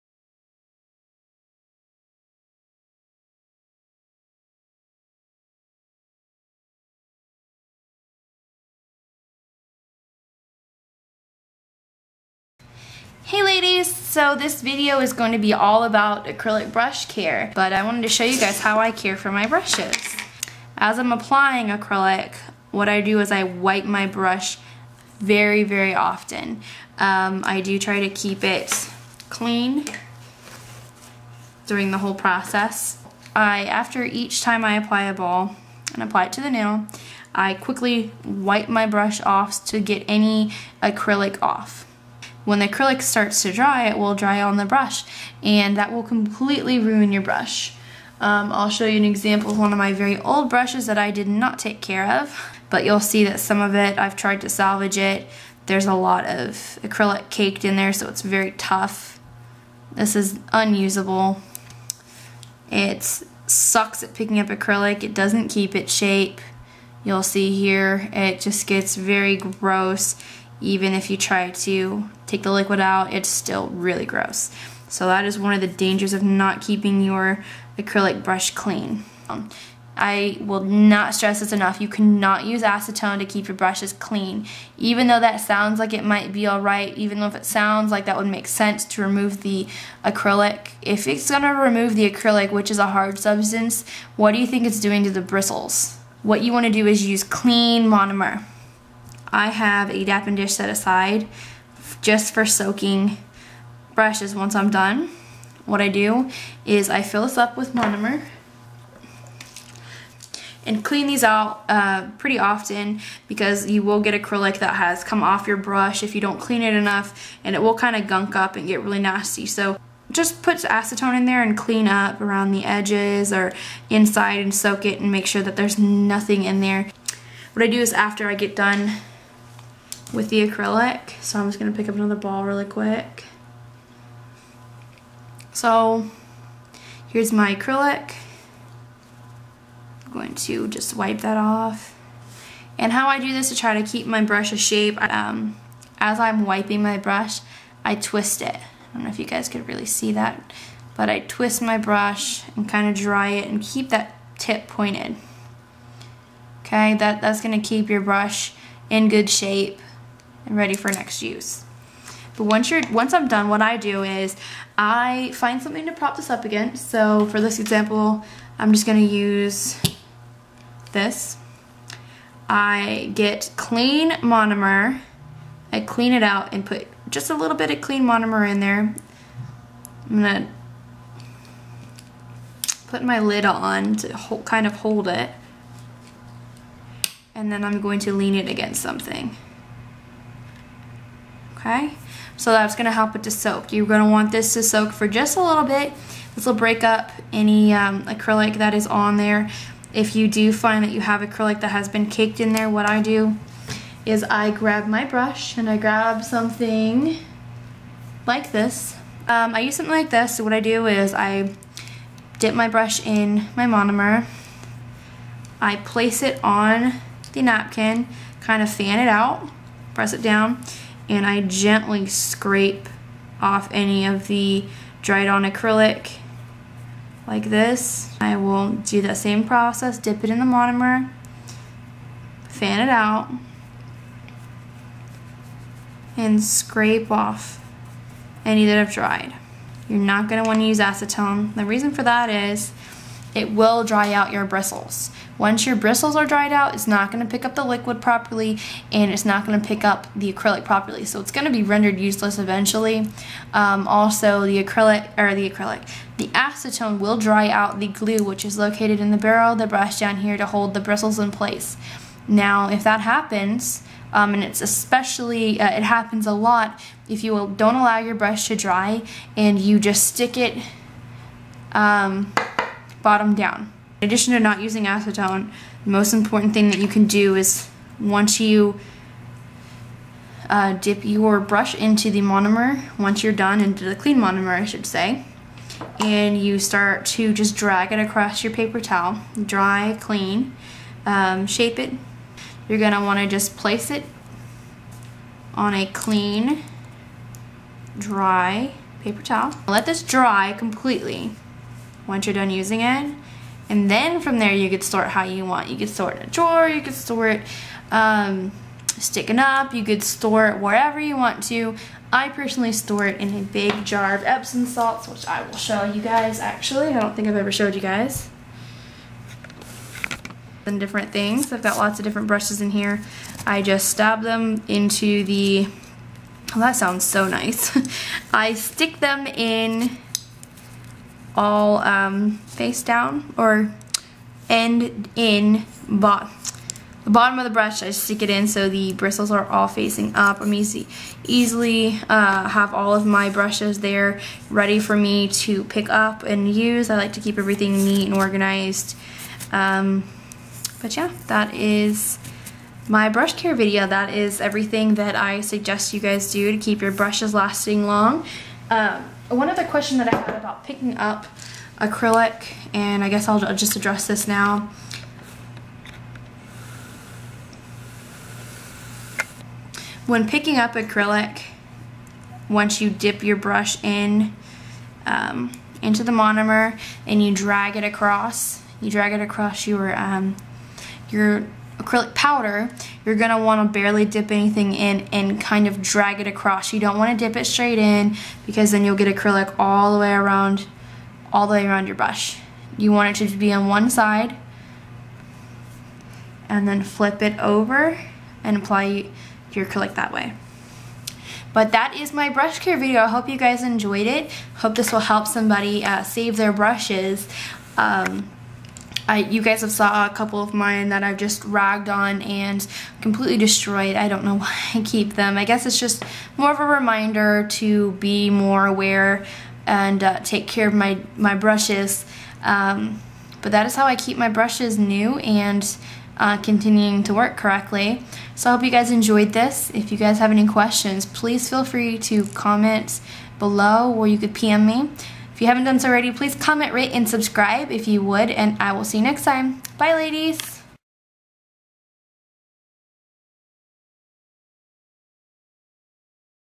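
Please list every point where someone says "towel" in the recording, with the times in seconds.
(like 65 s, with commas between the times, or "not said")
288 s, 299 s.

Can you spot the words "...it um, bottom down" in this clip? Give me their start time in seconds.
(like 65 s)
270 s.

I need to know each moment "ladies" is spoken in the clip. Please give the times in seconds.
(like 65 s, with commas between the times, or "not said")
13 s, 439 s.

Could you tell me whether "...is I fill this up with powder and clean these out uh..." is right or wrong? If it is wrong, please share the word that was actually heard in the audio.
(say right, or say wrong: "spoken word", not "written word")
wrong: "monomer", not "powder".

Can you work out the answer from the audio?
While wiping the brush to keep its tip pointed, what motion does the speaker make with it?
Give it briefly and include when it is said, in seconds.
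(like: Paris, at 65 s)
twist it, at 147 s.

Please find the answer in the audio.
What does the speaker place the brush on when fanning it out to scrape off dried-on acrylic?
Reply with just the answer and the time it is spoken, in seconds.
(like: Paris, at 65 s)
napkin, at 217 s.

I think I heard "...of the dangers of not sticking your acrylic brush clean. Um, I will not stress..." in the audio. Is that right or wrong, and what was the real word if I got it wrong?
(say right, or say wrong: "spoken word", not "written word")
wrong: "keeping", not "sticking".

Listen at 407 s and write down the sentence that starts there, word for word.
Um, I, you guys have saw a couple of mine that I've just ragged on and completely destroyed.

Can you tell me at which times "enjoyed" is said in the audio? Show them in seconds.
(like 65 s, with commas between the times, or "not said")
403 s, 428 s.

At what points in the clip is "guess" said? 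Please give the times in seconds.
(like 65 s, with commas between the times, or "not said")
363 s, 415 s.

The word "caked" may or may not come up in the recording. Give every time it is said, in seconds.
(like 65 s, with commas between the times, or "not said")
57 s, 202 s.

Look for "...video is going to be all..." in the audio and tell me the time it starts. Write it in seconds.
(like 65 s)
14 s.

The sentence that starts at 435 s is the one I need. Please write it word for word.
If you haven't done so already, please comment, rate, and subscribe if you would, and I will see you next time.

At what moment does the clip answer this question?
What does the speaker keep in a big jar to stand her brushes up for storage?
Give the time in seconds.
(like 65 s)
314 s.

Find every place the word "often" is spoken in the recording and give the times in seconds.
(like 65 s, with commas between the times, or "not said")
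25 s, 112 s.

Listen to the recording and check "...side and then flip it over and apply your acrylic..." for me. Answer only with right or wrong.
right.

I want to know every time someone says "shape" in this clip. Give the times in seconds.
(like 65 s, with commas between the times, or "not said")
65 s, 144 s, 159 s, 291 s.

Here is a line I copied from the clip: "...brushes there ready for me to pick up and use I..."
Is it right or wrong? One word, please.
right.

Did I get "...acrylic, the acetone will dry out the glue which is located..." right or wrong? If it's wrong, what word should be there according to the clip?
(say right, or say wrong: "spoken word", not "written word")
right.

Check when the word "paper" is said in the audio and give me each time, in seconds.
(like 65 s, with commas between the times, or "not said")
288 s, 299 s.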